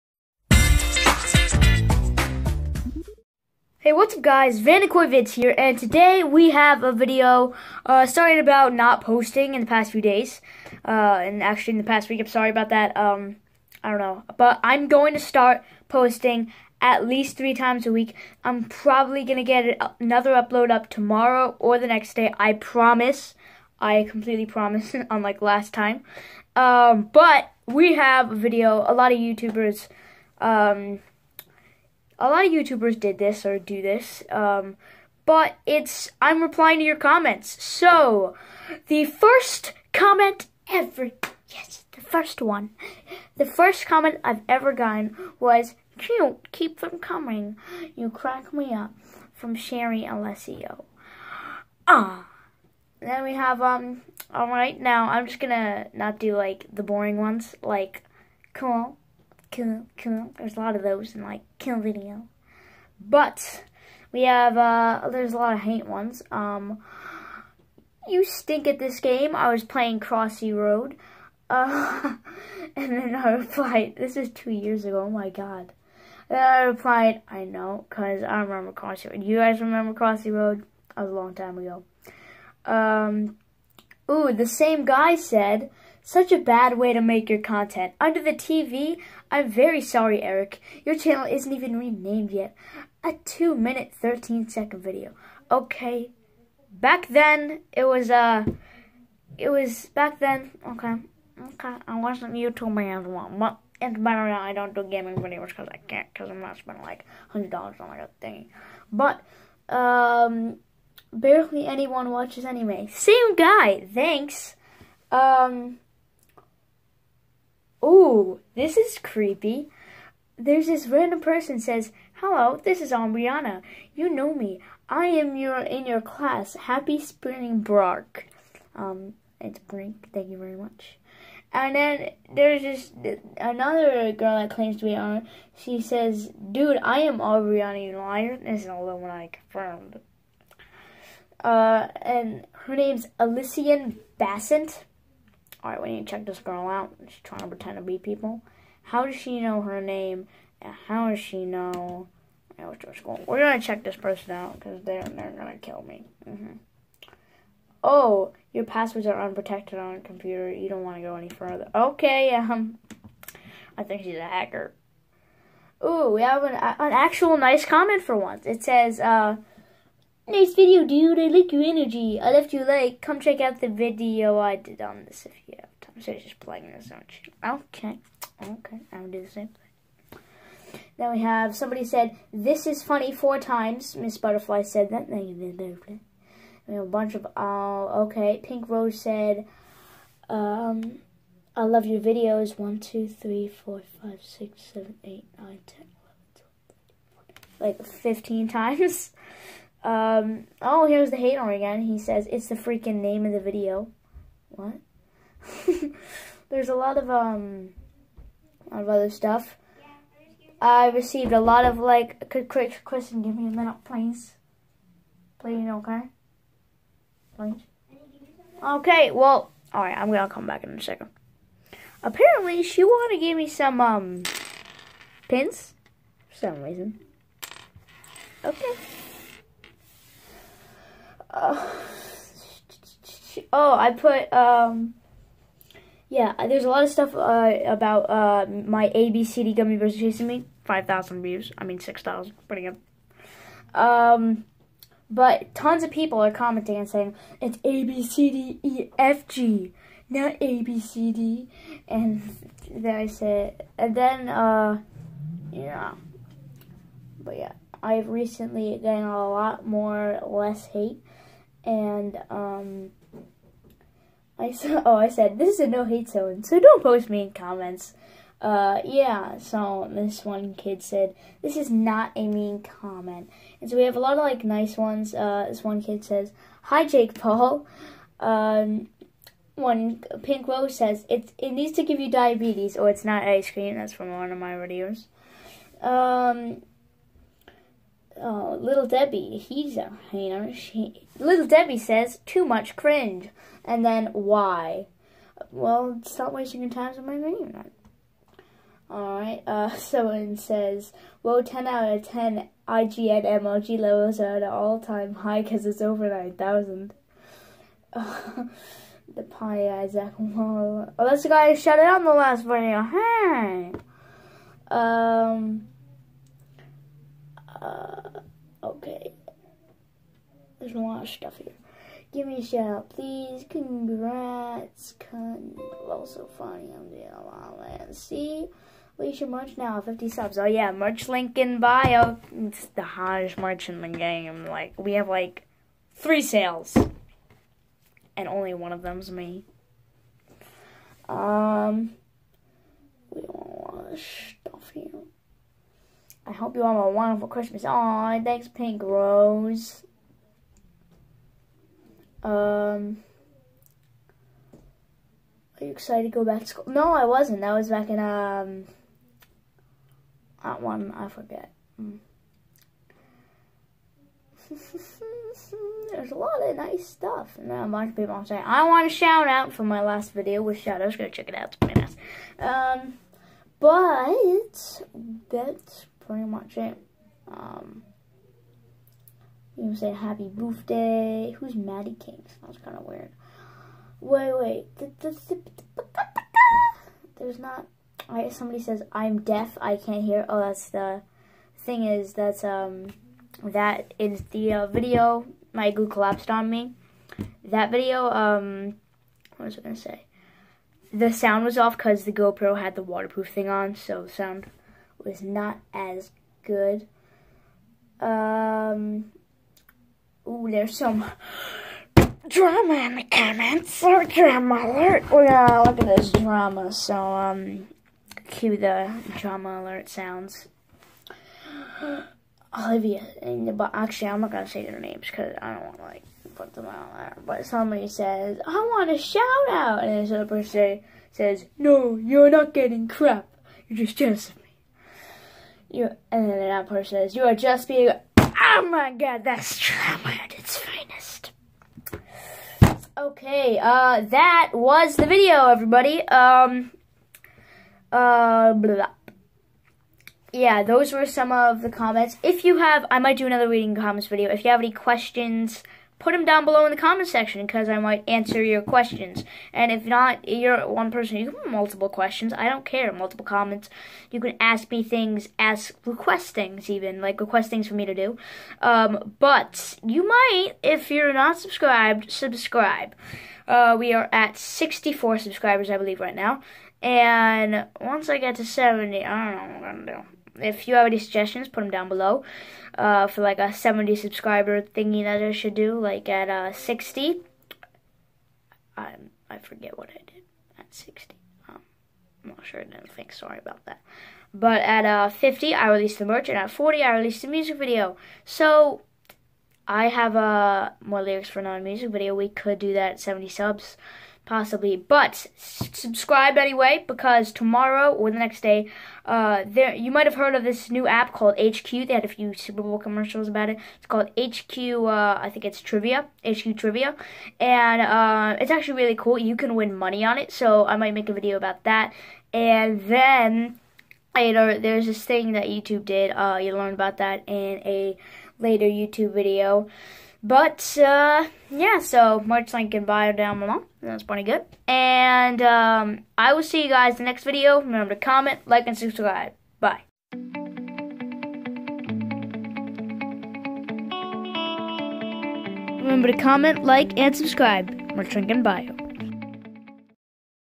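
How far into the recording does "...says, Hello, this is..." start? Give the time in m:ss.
2:01.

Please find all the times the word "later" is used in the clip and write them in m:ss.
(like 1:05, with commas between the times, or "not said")
8:44, 8:48.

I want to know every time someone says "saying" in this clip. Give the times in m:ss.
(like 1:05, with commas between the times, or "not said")
4:06, 6:08.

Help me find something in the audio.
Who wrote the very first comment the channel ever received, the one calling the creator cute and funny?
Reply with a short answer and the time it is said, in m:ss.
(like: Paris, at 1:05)
Sherry Alessio, at 0:49.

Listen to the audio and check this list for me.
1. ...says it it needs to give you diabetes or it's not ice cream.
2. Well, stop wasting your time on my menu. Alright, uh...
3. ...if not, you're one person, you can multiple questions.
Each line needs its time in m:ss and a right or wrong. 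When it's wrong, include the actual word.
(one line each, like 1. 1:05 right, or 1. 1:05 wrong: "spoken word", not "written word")
1. 4:40 right
2. 4:55 right
3. 7:39 right.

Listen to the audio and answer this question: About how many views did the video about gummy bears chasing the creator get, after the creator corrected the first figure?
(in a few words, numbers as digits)
6,000.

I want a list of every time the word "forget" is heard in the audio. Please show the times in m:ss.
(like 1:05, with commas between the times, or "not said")
6:01, 8:09.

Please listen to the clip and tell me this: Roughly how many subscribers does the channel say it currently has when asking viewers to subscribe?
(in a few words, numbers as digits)
64.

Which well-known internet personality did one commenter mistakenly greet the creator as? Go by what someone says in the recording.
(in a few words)
Jake Paul.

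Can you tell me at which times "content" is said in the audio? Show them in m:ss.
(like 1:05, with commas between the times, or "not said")
1:27.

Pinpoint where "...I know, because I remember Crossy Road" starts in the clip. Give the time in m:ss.
1:17.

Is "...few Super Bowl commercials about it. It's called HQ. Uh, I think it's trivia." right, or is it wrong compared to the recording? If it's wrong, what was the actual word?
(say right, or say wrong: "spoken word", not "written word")
right.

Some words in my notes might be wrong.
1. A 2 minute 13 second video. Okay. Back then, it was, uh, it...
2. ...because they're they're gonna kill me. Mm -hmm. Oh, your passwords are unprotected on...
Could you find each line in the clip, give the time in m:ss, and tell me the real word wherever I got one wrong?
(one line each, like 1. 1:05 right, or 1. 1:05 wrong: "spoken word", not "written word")
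1. 1:33 right
2. 2:34 right.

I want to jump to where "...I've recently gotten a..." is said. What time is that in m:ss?
4:17.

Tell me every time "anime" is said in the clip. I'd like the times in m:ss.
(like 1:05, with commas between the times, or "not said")
1:52.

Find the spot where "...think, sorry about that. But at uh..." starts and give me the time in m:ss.
8:12.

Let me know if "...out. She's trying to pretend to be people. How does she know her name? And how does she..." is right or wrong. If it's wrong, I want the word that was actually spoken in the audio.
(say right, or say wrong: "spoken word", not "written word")
right.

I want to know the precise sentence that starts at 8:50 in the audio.
But, uh, yeah, so much and bio down below.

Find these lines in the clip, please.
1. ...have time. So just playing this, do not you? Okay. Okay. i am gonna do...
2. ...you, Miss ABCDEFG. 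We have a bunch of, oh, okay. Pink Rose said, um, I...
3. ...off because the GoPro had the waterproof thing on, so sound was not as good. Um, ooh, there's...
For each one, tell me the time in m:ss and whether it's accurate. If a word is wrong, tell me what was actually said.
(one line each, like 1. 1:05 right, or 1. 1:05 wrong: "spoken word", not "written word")
1. 2:55 right
2. 3:05 wrong: "Butterfly", not "ABCDEFG"
3. 6:41 right.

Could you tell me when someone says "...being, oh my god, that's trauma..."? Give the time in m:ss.
7:17.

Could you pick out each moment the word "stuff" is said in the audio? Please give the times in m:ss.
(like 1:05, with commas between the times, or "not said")
3:29, 3:56, 5:21, 6:06.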